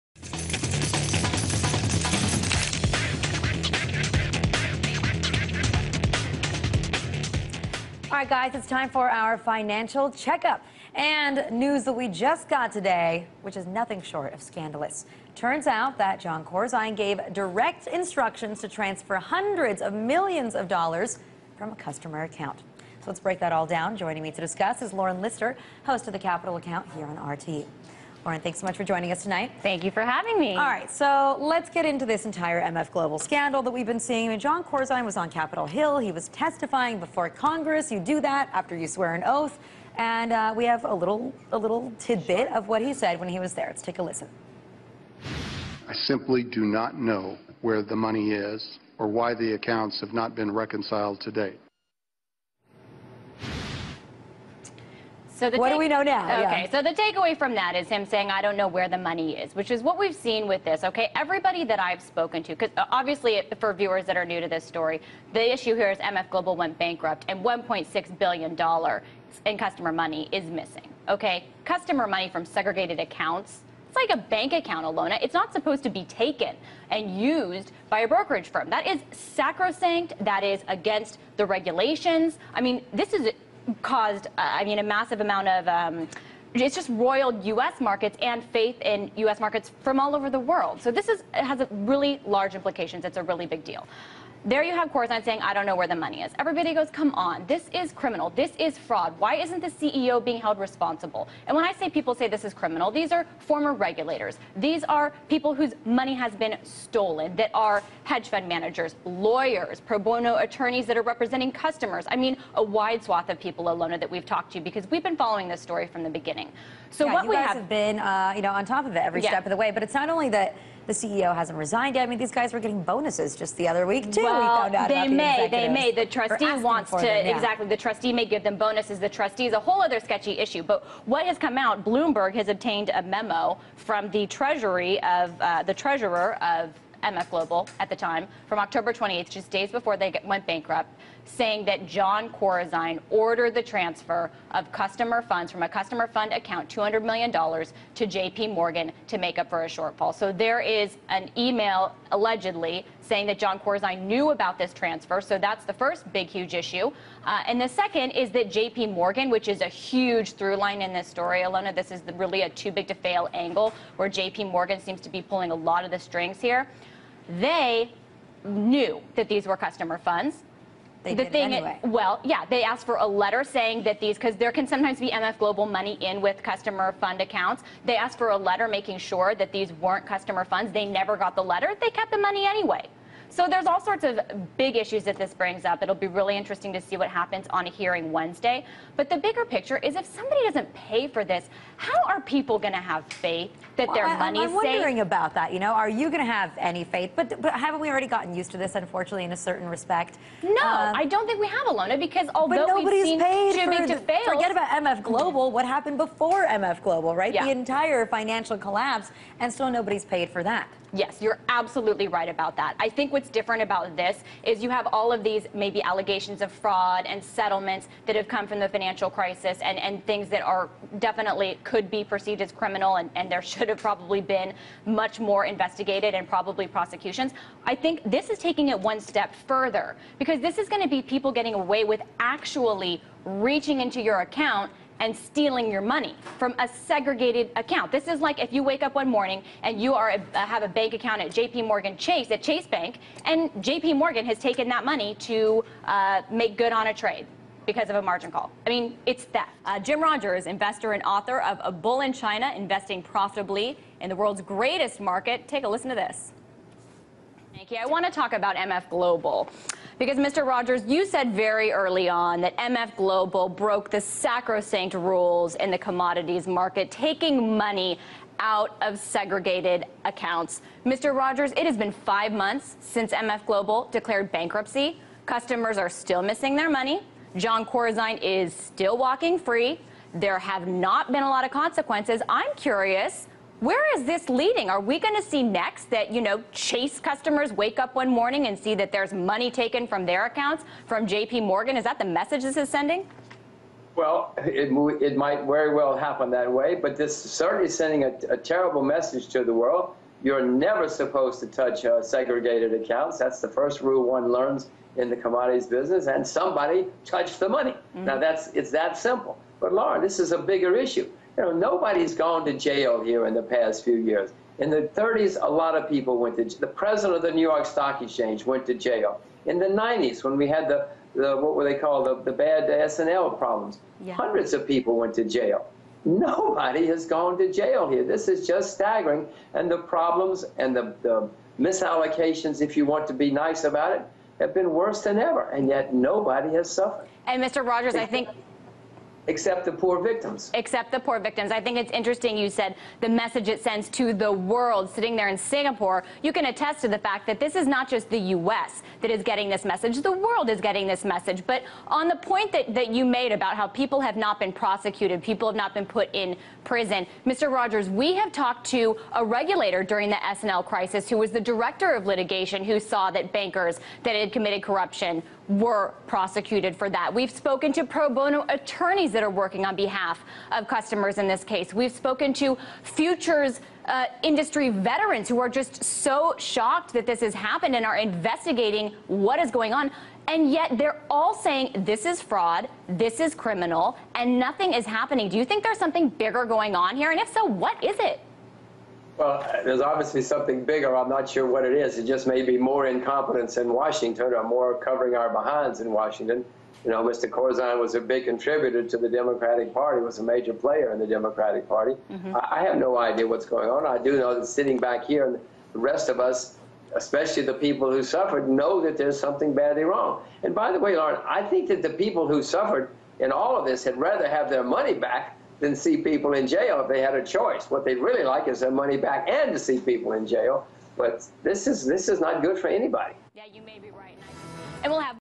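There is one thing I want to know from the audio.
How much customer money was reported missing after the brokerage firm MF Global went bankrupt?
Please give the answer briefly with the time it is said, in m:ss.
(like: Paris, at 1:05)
$1.6 billion, at 1:07.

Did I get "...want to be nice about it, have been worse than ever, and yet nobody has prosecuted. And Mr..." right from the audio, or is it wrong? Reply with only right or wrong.
wrong.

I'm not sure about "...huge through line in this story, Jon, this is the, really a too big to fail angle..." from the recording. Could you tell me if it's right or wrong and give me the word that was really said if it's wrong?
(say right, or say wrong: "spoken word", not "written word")
wrong: "Alyona", not "Jon".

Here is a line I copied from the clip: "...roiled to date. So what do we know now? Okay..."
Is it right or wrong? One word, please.
wrong.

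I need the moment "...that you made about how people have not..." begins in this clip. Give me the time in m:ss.
5:52.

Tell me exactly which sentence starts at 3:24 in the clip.
Forget about MF Global, what happened before MF Global, right?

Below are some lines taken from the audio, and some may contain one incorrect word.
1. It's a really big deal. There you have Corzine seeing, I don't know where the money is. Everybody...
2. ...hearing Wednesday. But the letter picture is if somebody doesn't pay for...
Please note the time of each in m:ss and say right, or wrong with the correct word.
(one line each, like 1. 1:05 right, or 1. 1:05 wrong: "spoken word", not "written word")
1. 1:33 wrong: "saying", not "seeing"
2. 3:07 wrong: "bigger", not "letter".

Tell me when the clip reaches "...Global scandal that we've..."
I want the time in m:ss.
0:32.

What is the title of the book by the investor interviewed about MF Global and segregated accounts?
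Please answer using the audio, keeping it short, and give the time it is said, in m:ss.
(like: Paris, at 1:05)
A Bull in China, at 4:11.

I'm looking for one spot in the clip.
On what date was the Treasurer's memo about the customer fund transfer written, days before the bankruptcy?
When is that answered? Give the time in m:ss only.
2:18.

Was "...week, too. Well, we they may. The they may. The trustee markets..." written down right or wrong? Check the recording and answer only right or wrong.
wrong.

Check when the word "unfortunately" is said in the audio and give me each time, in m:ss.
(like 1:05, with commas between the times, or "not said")
3:18.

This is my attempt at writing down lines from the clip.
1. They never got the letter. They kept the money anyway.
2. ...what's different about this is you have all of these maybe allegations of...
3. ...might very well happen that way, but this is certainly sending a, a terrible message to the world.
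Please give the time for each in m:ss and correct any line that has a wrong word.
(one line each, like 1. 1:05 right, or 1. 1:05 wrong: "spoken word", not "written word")
1. 3:00 right
2. 3:33 right
3. 4:55 right.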